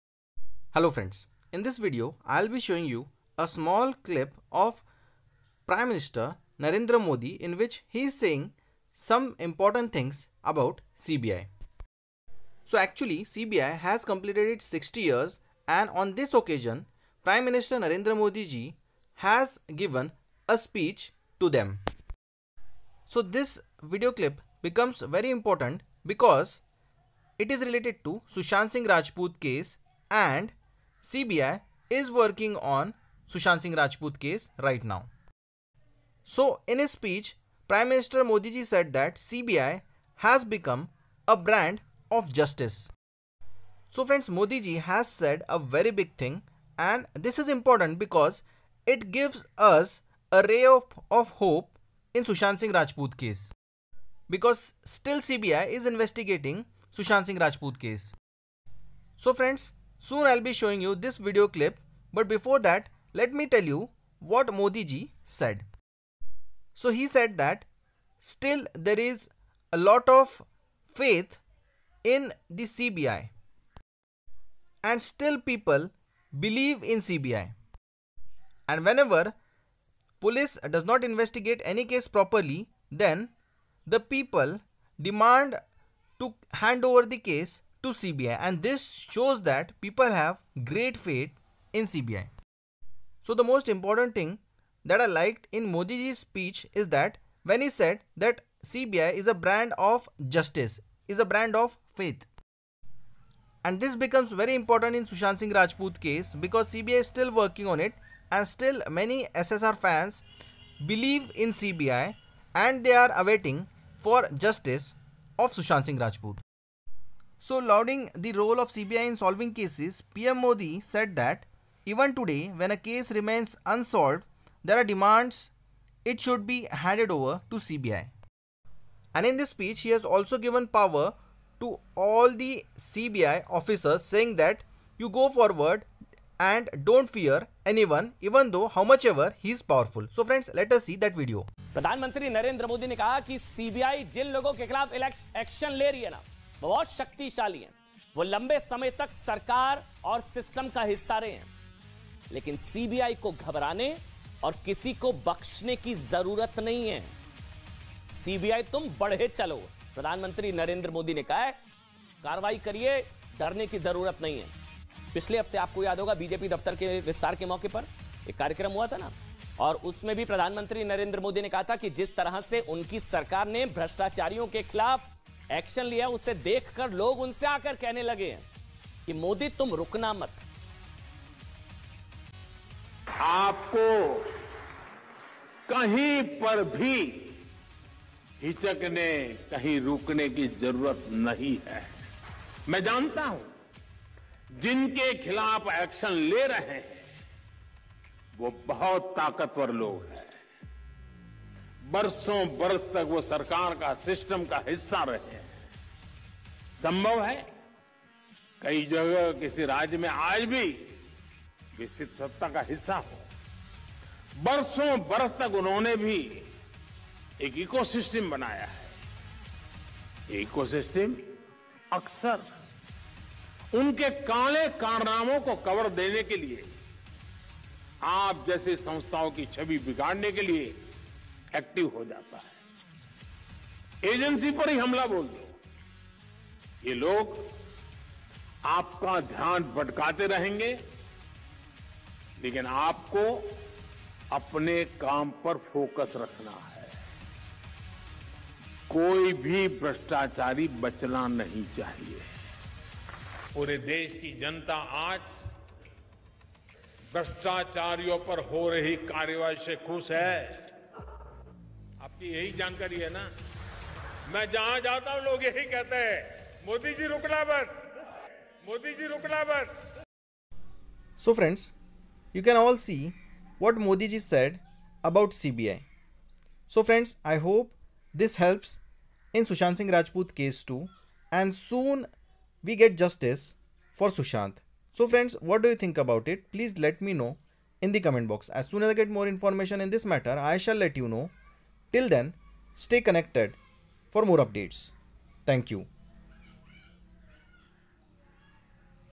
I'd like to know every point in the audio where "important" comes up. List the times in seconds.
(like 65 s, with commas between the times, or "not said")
9 s, 25 s, 47 s, 93 s, 104 s.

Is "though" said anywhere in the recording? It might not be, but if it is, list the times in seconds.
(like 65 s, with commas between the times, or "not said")
138 s.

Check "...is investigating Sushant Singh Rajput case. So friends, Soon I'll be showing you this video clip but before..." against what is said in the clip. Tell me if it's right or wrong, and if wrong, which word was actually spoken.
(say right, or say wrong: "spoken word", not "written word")
right.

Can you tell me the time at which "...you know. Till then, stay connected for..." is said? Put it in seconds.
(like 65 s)
290 s.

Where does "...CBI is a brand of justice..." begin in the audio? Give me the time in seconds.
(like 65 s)
98 s.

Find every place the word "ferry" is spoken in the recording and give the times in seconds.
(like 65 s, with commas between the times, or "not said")
not said.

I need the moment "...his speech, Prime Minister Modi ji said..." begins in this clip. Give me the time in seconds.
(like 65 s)
36 s.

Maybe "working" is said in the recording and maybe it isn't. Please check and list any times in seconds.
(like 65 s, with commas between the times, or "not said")
32 s, 107 s.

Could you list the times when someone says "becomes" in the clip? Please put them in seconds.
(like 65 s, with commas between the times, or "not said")
24 s, 40 s, 103 s.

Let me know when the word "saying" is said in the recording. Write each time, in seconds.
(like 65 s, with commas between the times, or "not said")
8 s, 134 s.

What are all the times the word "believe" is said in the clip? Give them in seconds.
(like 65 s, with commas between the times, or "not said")
76 s, 110 s.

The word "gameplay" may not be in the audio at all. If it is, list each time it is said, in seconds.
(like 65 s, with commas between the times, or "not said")
not said.